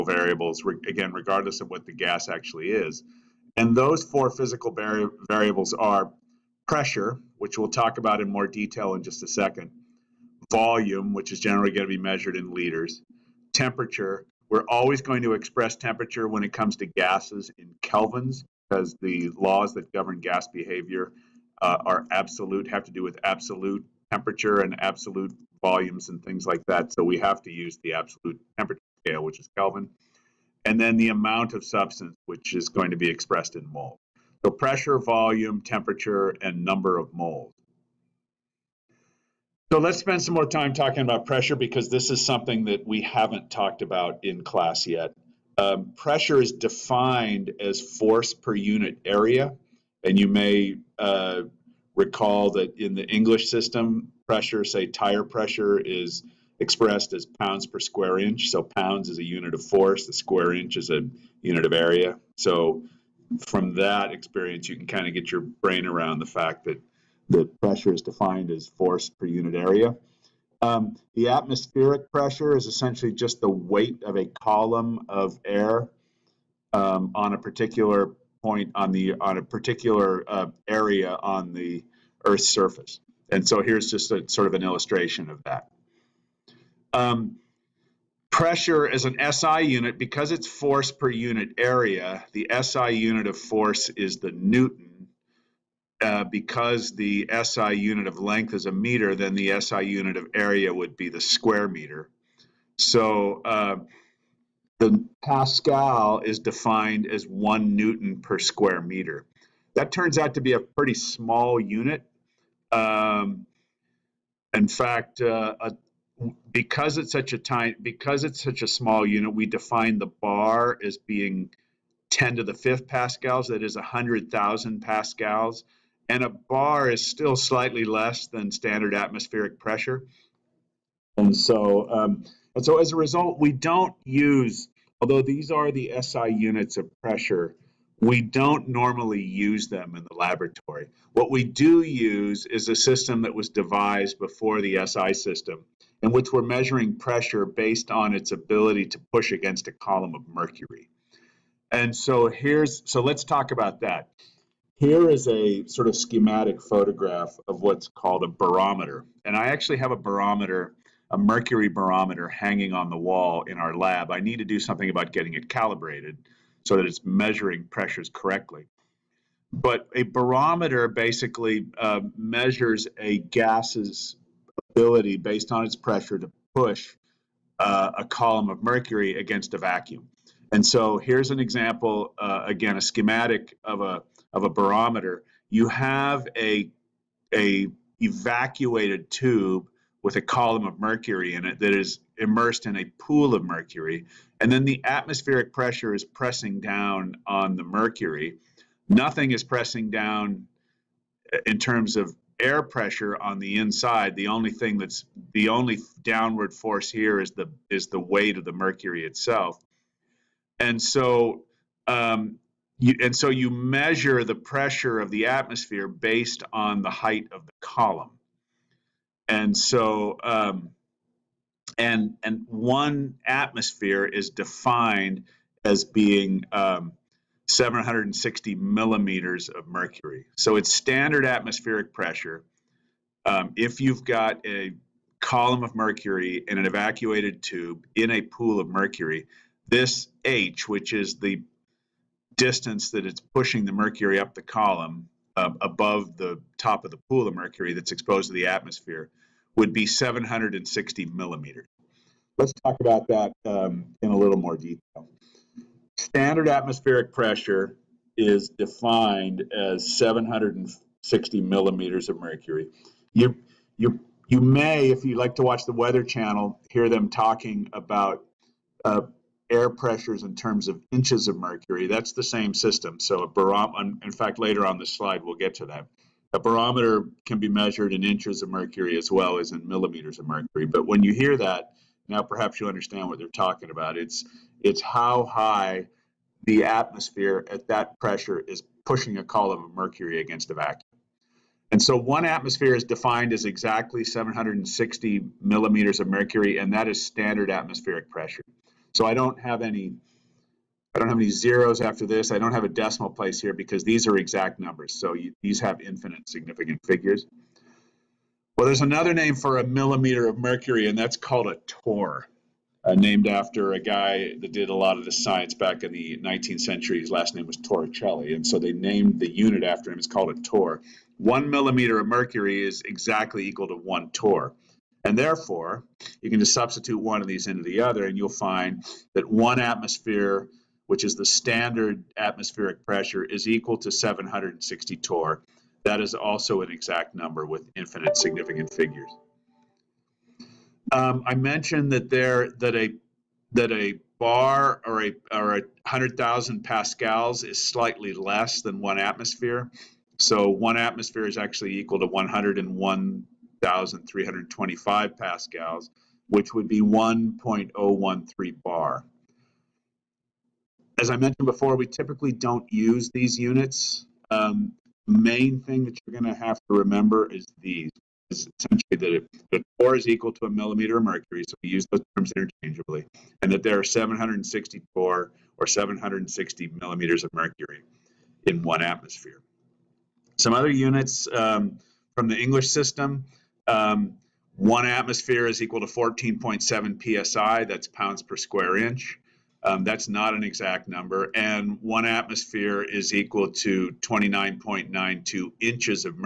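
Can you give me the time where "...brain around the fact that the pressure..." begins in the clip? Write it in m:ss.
1:05.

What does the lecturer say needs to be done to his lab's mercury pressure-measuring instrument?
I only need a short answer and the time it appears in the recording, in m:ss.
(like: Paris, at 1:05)
calibrated, at 2:45.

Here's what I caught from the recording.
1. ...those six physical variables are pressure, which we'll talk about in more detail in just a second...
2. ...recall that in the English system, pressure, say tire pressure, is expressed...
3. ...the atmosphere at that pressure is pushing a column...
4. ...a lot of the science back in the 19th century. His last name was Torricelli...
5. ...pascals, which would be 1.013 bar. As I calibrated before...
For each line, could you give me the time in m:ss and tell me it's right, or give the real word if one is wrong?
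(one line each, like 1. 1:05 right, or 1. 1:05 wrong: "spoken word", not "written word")
1. 0:03 wrong: "four", not "six"
2. 0:51 right
3. 4:46 right
4. 5:14 right
5. 5:55 wrong: "mentioned", not "calibrated".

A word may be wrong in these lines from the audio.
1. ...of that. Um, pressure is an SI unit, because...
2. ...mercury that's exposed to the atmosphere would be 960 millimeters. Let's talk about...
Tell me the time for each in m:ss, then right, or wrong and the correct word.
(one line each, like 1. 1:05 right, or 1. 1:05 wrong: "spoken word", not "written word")
1. 1:25 right
2. 4:07 wrong: "760", not "960".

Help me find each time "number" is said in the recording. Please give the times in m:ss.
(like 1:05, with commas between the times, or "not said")
0:36, 5:04, 5:37, 6:30.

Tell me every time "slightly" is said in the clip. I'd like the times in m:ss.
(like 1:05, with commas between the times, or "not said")
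2:07, 5:47.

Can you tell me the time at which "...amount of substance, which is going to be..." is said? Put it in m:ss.
0:31.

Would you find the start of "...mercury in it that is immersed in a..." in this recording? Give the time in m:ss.
3:10.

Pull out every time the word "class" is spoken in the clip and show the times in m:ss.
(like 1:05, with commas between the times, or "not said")
0:44.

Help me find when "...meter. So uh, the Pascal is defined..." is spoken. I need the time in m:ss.
1:41.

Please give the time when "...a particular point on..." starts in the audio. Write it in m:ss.
1:17.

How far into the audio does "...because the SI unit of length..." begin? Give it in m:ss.
1:36.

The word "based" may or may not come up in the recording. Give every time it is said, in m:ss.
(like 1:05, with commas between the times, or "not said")
2:27, 2:55, 3:35.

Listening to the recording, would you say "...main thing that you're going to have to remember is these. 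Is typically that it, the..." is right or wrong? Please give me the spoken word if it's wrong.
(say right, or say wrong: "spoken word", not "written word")
wrong: "essentially", not "typically".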